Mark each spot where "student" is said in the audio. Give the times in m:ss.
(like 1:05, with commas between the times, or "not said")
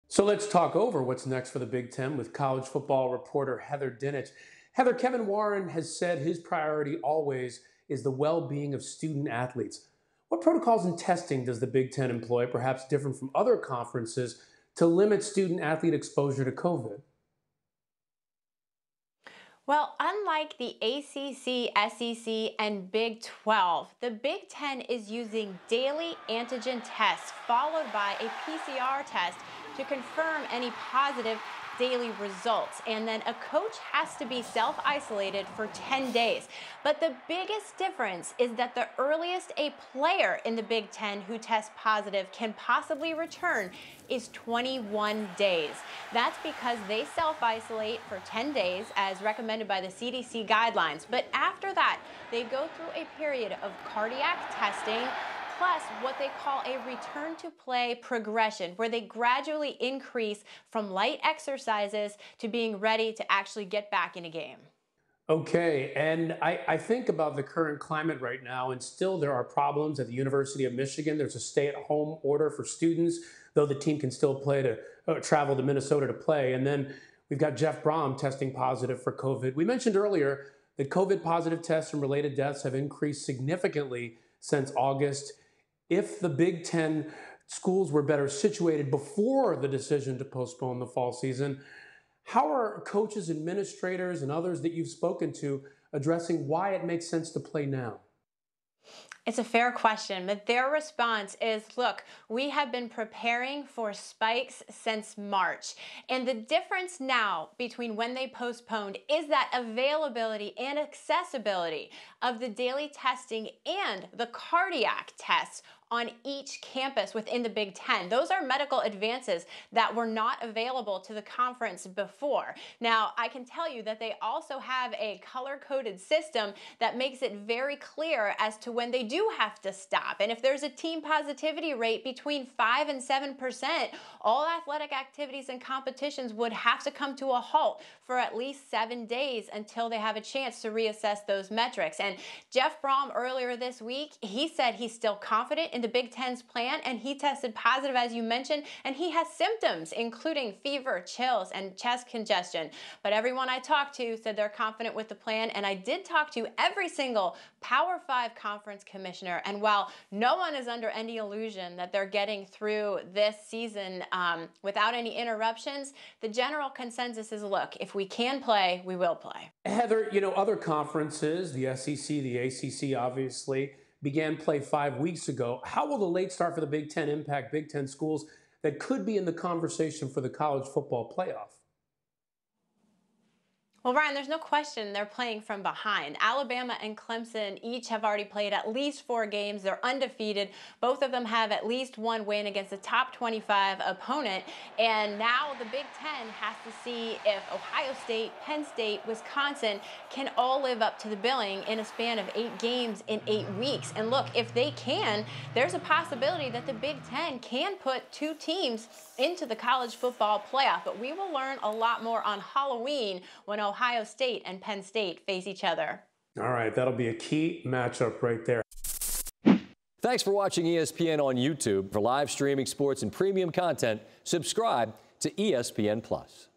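0:08, 0:15, 1:12.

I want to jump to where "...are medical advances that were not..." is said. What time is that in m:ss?
1:58.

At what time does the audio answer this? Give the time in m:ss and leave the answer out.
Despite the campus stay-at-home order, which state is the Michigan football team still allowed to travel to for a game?
1:15.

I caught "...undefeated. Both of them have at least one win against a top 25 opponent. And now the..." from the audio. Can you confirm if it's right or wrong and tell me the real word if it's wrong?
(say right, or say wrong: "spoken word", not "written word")
right.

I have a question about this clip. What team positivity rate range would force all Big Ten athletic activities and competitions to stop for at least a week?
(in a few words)
5 to 7%.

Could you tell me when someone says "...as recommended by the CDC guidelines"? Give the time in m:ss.
0:48.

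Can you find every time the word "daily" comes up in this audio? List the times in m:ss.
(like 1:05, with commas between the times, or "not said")
0:25, 0:31, 1:52.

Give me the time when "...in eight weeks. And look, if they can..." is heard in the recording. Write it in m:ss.
3:23.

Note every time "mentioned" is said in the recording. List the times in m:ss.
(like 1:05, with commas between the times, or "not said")
1:19, 2:28.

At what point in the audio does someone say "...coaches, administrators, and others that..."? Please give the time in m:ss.
1:32.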